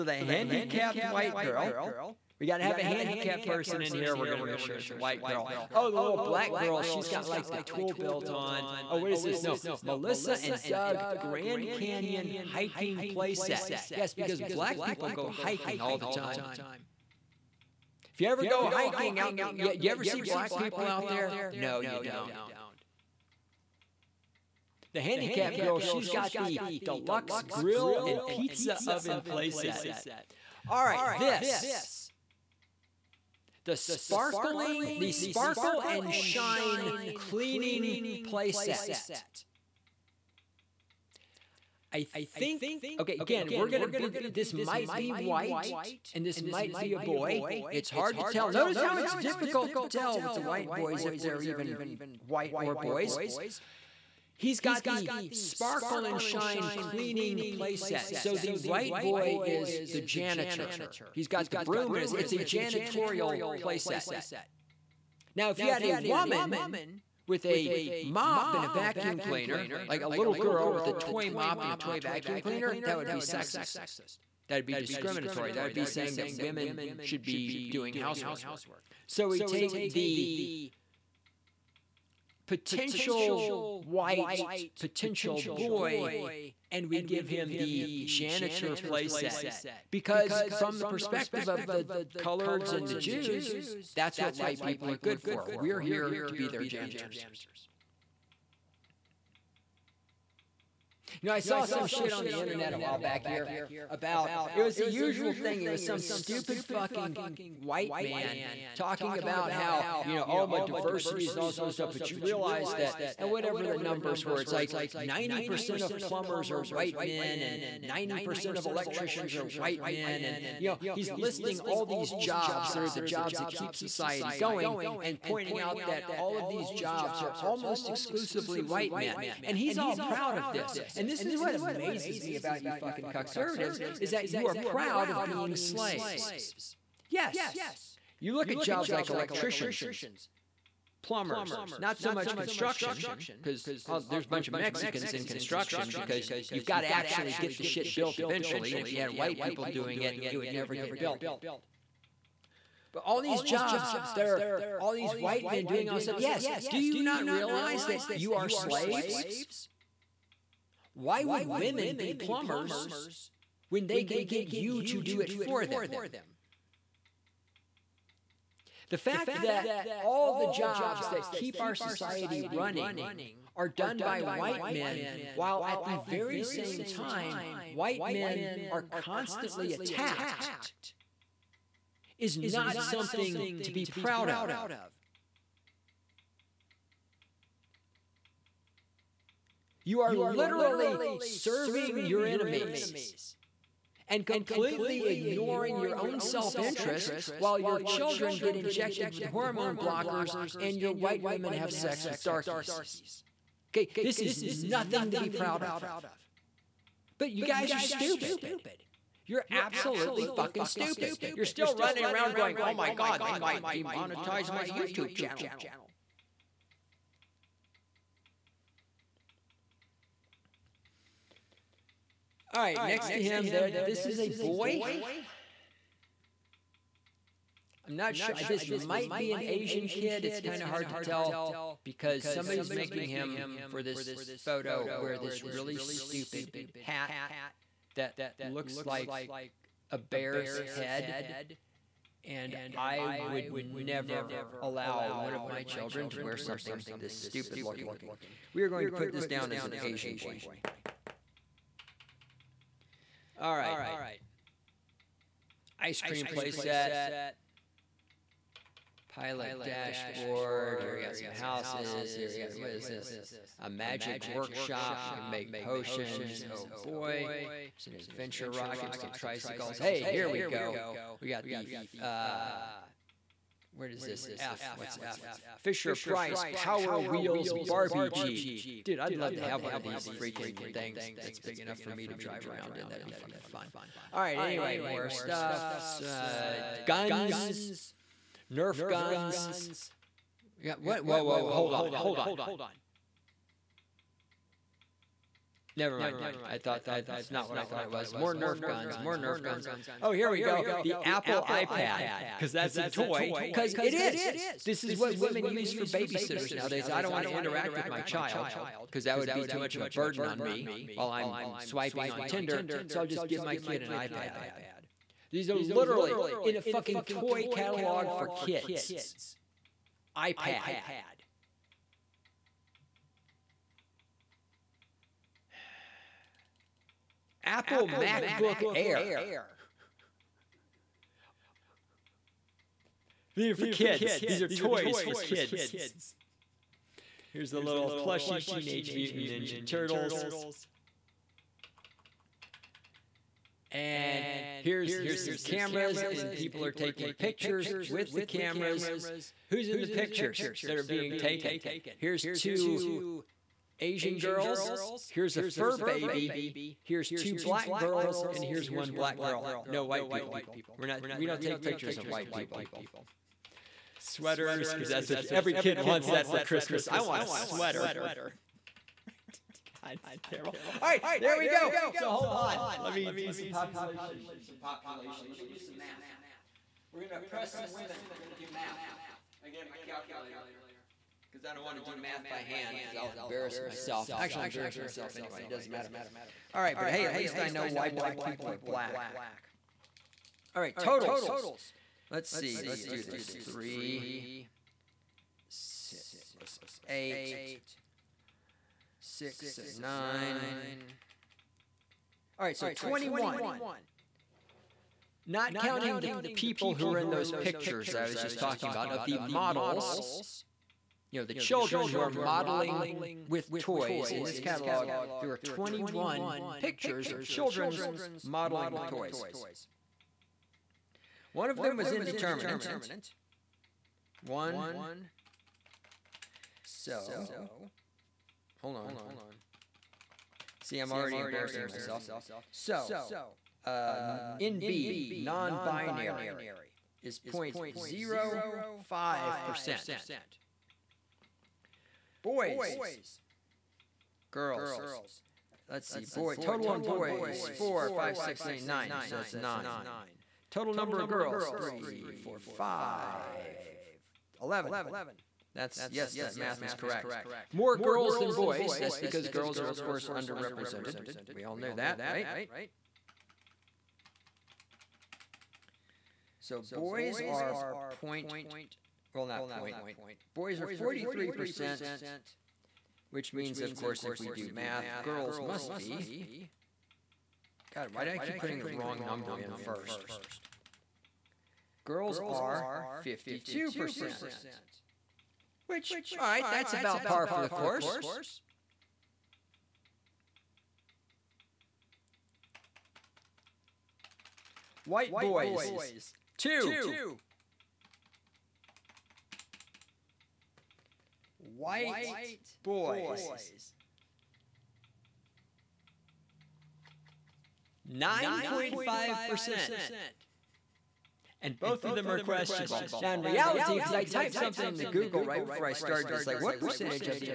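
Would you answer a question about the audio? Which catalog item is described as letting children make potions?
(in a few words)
A magic workshop.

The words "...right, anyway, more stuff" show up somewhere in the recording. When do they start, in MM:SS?
04:44.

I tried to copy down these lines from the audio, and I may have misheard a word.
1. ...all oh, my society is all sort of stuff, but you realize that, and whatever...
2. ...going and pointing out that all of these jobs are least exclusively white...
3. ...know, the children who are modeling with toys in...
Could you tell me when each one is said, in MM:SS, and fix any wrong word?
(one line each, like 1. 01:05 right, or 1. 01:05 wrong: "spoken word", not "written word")
1. 01:50 wrong: "diversity", not "society"
2. 02:04 wrong: "almost", not "least"
3. 06:51 right.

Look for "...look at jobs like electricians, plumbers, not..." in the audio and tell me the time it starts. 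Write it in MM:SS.
02:18.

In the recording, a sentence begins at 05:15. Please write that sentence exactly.
These are literally in a fucking toy catalog for kids.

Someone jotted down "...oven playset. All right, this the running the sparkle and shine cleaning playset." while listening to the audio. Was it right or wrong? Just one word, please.
wrong.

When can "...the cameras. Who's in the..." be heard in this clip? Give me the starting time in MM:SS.
05:48.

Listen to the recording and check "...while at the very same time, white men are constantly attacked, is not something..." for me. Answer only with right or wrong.
right.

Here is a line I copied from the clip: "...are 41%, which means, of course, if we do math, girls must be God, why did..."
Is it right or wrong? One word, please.
wrong.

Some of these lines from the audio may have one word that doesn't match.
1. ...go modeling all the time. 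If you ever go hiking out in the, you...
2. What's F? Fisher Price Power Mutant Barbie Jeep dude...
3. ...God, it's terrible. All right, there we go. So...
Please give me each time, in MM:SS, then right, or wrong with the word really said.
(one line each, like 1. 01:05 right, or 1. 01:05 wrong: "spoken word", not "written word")
1. 00:15 wrong: "hiking", not "modeling"
2. 04:34 wrong: "Wheels", not "Mutant"
3. 06:09 right.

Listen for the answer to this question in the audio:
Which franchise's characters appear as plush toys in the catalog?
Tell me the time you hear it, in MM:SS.
05:38.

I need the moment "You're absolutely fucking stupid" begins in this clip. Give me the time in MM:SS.
03:29.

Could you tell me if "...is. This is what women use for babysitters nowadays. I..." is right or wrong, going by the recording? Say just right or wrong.
right.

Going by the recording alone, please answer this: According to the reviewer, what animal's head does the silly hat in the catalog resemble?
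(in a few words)
A bear's head.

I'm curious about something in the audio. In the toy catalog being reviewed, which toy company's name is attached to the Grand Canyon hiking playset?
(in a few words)
Melissa and Doug.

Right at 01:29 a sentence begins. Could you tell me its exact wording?
Because from the perspective of the coloreds and the Jews, that's what white people are good for.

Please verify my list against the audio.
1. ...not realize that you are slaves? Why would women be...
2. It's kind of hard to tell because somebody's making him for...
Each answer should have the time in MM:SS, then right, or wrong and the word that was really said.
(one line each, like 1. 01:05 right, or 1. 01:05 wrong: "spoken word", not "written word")
1. 02:37 right
2. 03:50 right.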